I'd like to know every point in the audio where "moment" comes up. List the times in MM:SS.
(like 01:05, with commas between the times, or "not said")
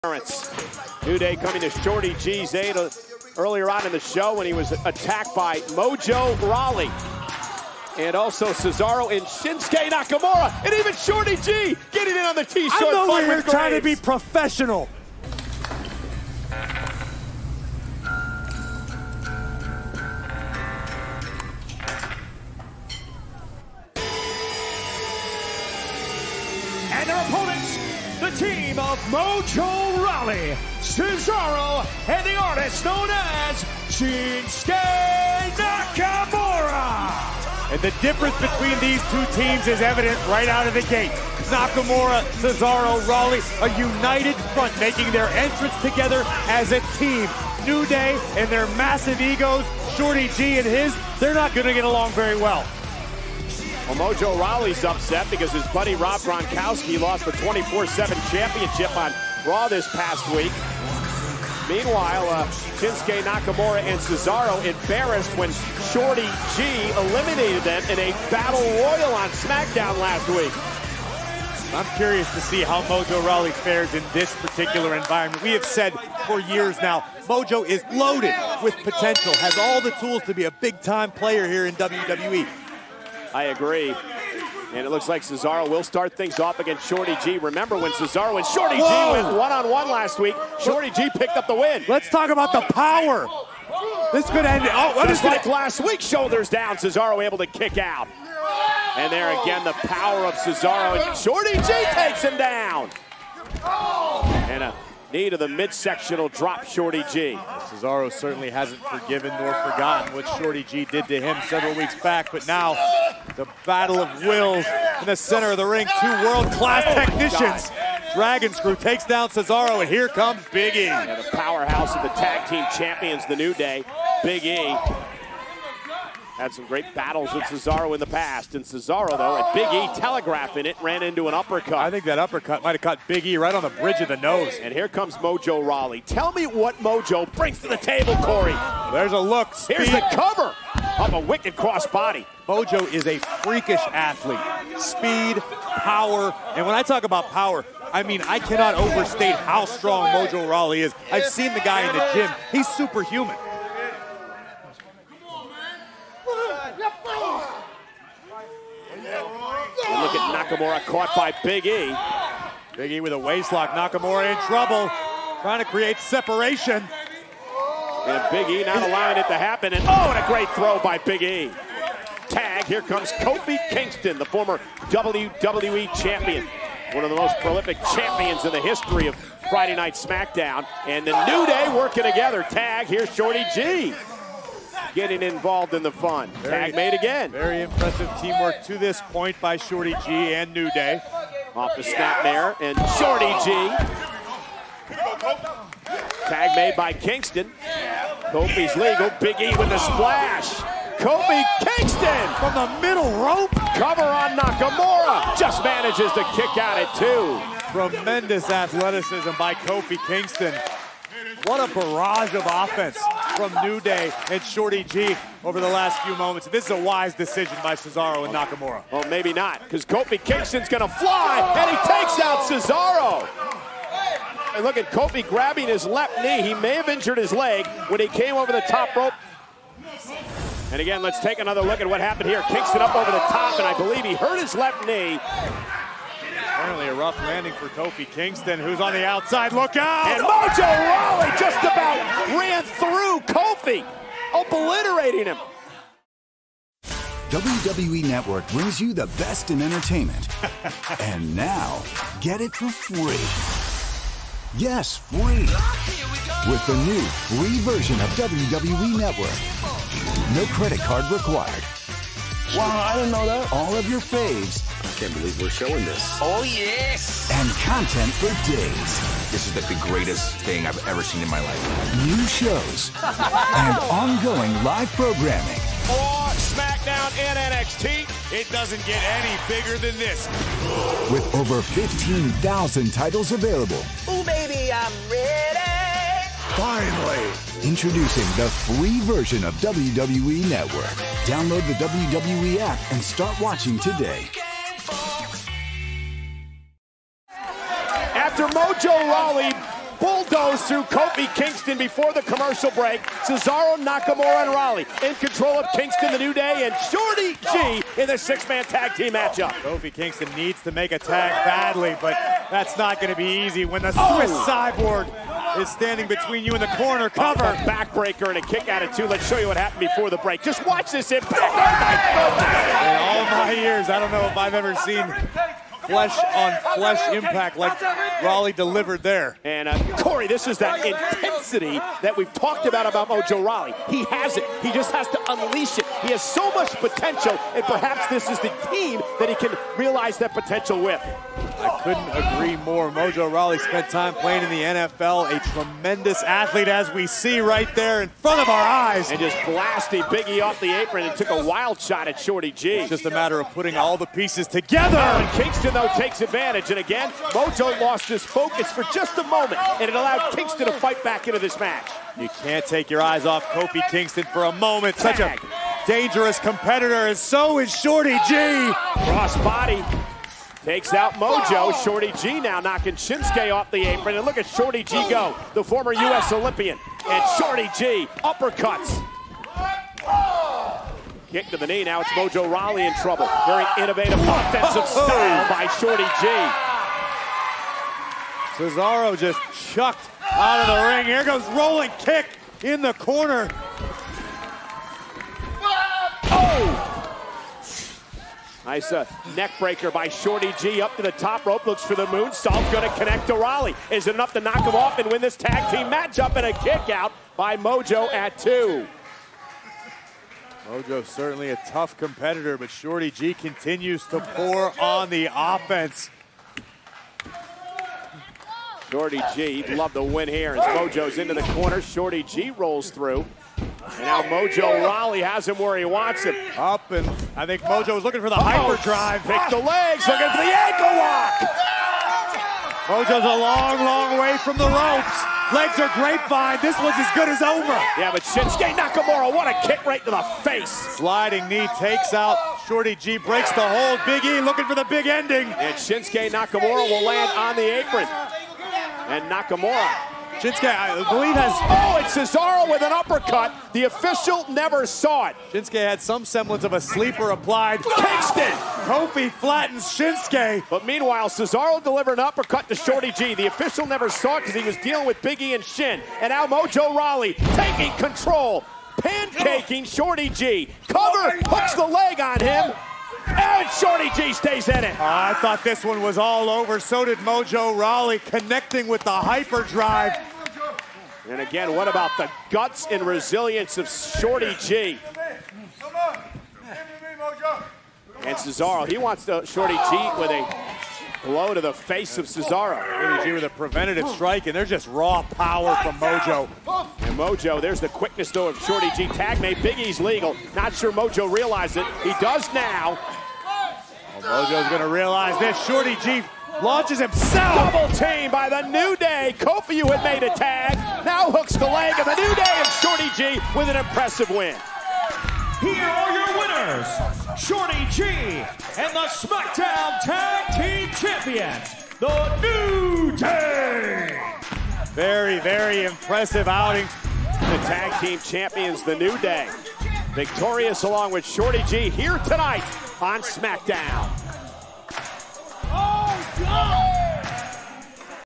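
03:36, 05:59, 06:04.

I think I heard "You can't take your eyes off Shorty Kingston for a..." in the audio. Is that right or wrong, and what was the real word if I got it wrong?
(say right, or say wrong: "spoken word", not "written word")
wrong: "Kofi", not "Shorty".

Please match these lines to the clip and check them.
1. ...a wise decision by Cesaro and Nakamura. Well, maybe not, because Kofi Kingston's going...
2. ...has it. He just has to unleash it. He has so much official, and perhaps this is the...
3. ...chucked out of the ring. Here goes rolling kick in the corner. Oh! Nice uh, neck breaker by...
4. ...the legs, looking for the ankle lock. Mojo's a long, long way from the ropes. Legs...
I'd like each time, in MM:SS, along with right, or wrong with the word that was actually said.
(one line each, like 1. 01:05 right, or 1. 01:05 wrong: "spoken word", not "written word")
1. 03:36 right
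2. 05:34 wrong: "potential", not "official"
3. 06:29 right
4. 07:09 right.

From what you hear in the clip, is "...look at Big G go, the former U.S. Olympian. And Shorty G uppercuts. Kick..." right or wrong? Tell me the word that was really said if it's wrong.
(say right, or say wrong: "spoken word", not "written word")
wrong: "Shorty", not "Big".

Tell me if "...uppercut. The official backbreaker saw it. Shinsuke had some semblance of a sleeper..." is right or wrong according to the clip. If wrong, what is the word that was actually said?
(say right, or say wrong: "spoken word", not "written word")
wrong: "never", not "backbreaker".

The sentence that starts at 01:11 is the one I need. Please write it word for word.
I'm curious to see how Mojo Rawley fares in this particular environment.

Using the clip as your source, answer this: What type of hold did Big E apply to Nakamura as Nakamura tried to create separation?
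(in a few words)
Waistlock.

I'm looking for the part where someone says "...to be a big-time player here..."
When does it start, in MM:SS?
01:20.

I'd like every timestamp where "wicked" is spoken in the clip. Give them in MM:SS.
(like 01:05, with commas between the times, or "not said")
02:21.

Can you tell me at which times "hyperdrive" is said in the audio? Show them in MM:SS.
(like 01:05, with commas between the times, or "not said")
07:08, 07:59.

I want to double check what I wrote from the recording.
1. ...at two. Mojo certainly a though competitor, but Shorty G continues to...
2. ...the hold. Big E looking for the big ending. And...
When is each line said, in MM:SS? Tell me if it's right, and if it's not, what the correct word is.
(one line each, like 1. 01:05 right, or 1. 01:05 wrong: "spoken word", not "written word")
1. 06:48 wrong: "tough", not "though"
2. 07:23 right.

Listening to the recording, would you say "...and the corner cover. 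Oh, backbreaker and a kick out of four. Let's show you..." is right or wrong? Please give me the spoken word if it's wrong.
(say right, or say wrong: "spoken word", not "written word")
wrong: "two", not "four".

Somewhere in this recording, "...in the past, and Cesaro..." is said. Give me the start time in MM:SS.
02:07.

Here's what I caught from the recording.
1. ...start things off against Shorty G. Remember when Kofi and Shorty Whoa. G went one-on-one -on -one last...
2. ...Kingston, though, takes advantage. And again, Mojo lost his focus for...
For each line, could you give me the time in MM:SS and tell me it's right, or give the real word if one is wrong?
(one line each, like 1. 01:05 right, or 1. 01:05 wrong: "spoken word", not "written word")
1. 01:25 wrong: "Cesaro", not "Kofi"
2. 05:55 right.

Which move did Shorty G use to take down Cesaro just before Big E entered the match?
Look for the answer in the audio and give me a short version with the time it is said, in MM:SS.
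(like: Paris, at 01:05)
Dragon Screw, at 01:58.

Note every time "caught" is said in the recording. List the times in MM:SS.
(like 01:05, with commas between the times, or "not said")
02:12, 02:40.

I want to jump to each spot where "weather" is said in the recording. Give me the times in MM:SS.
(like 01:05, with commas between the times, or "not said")
not said.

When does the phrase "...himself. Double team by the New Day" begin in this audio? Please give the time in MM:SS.
08:26.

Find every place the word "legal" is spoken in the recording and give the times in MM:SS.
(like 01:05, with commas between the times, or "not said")
03:18, 08:19.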